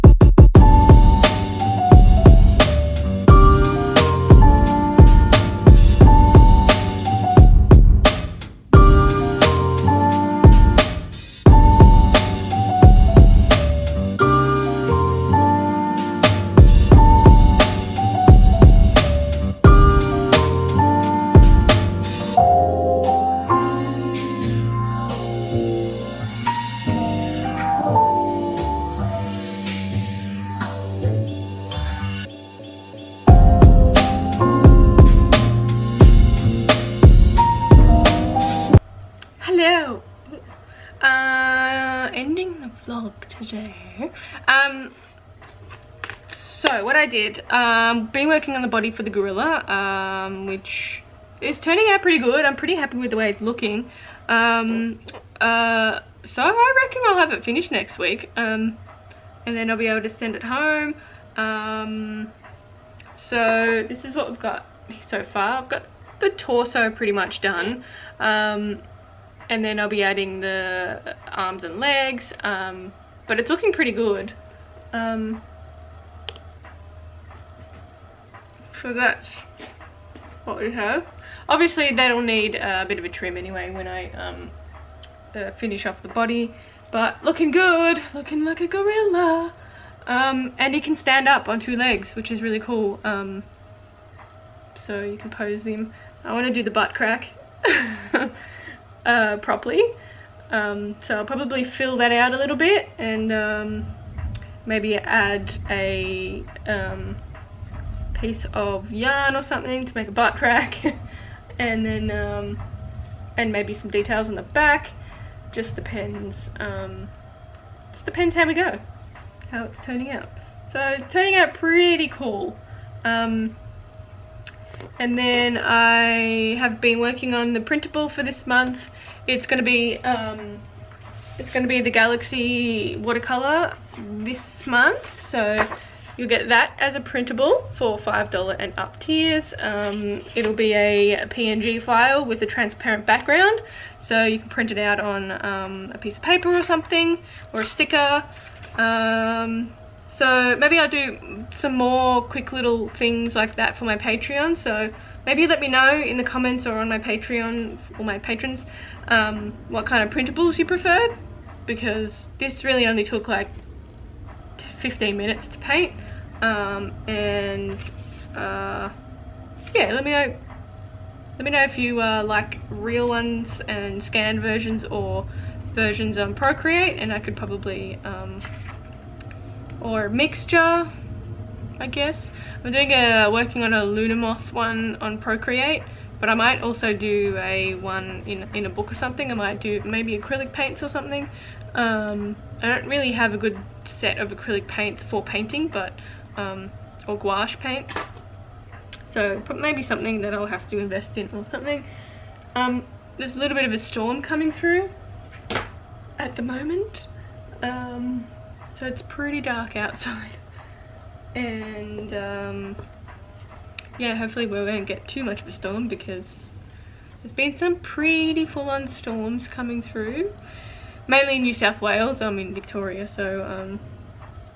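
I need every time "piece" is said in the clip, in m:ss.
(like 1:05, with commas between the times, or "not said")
1:48, 2:25.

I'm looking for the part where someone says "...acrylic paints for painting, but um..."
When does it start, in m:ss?
3:14.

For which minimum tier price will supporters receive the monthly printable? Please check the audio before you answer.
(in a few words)
$5.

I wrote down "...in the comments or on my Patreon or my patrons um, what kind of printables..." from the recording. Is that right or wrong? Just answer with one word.
right.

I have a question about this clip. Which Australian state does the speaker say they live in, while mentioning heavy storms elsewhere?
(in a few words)
Victoria.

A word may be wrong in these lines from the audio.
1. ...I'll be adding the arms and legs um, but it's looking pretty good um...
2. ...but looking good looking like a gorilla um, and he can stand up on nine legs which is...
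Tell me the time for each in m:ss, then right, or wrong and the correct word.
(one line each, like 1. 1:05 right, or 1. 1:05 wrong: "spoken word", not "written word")
1. 1:09 right
2. 1:26 wrong: "two", not "nine".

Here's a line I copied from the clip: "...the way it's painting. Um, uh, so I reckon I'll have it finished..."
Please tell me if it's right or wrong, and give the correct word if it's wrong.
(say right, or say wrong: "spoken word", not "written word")
wrong: "looking", not "painting".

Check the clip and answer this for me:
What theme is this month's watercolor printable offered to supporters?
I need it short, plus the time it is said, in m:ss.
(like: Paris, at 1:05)
Galaxy, at 2:11.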